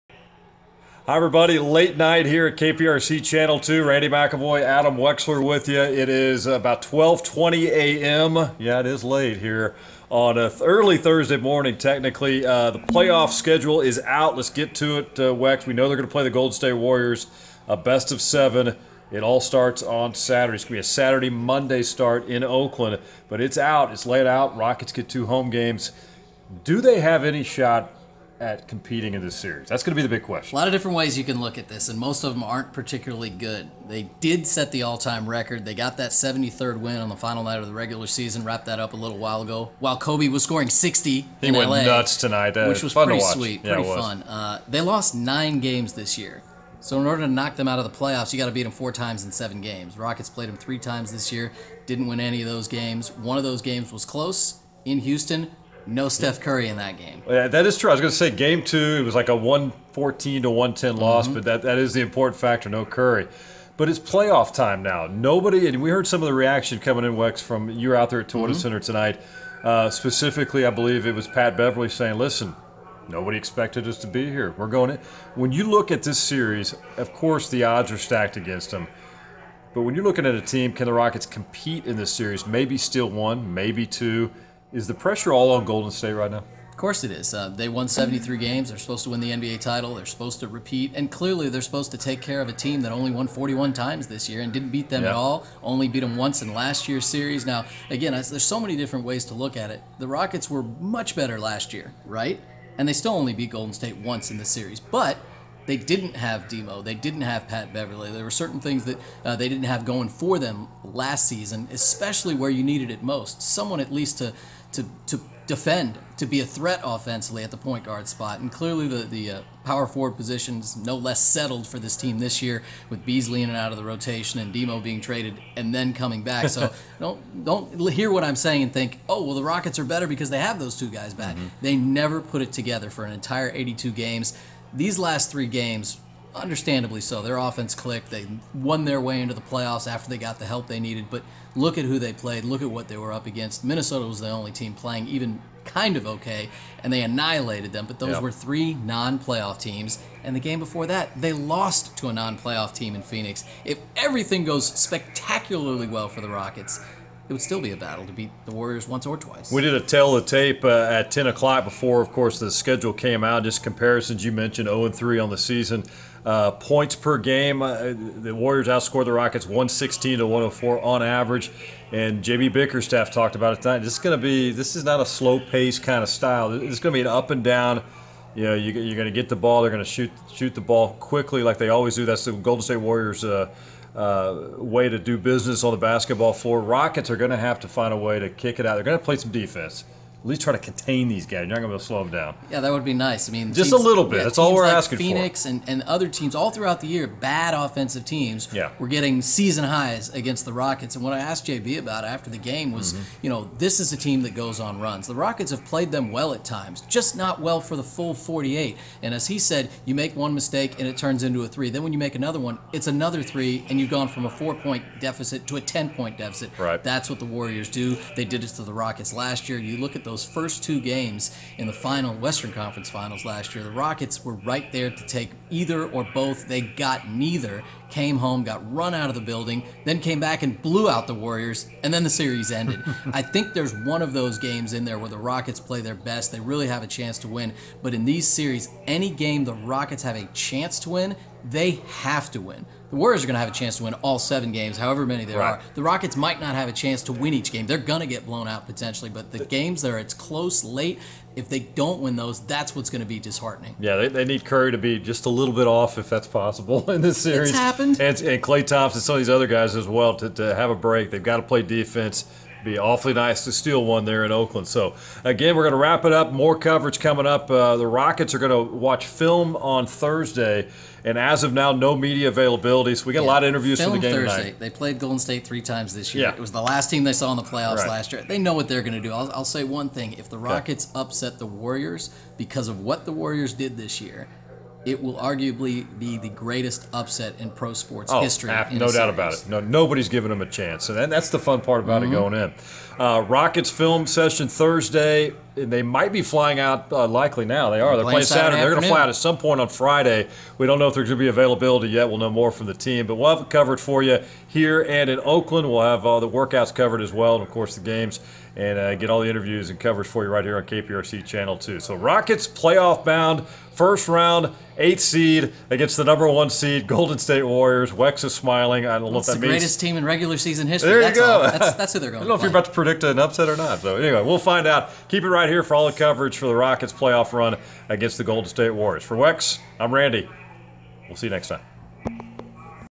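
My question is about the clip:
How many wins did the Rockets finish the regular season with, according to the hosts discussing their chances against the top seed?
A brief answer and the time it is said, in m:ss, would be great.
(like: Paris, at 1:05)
41, at 1:33.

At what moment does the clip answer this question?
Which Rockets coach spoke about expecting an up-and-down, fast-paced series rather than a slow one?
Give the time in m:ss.
2:52.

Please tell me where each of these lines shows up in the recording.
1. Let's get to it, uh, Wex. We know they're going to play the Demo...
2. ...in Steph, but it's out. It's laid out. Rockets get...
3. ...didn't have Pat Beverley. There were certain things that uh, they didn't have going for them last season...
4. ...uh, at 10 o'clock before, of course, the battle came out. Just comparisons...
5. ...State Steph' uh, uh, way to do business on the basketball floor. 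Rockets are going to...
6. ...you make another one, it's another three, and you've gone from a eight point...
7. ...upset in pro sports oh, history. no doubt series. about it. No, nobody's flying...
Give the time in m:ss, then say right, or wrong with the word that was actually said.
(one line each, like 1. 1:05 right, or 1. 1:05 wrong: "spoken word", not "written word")
1. 0:14 wrong: "Golden", not "Demo"
2. 0:22 wrong: "Oakland", not "Steph"
3. 1:46 right
4. 2:40 wrong: "schedule", not "battle"
5. 3:02 wrong: "Warriors", not "Steph"
6. 3:31 wrong: "four", not "eight"
7. 4:46 wrong: "giving", not "flying".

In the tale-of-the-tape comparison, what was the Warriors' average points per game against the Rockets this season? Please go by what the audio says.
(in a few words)
116.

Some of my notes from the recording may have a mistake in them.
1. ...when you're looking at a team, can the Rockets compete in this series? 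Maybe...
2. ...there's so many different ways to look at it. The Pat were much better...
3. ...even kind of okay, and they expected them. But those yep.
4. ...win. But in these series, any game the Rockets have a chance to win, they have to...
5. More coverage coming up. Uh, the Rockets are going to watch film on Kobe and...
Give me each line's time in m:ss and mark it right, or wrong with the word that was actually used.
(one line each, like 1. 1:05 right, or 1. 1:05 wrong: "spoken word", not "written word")
1. 1:19 right
2. 1:38 wrong: "Rockets", not "Pat"
3. 2:25 wrong: "annihilated", not "expected"
4. 3:57 right
5. 4:26 wrong: "Thursday", not "Kobe".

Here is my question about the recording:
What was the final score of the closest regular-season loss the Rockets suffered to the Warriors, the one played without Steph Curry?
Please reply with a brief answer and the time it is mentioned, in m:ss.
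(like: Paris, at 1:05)
114 to 110, at 0:59.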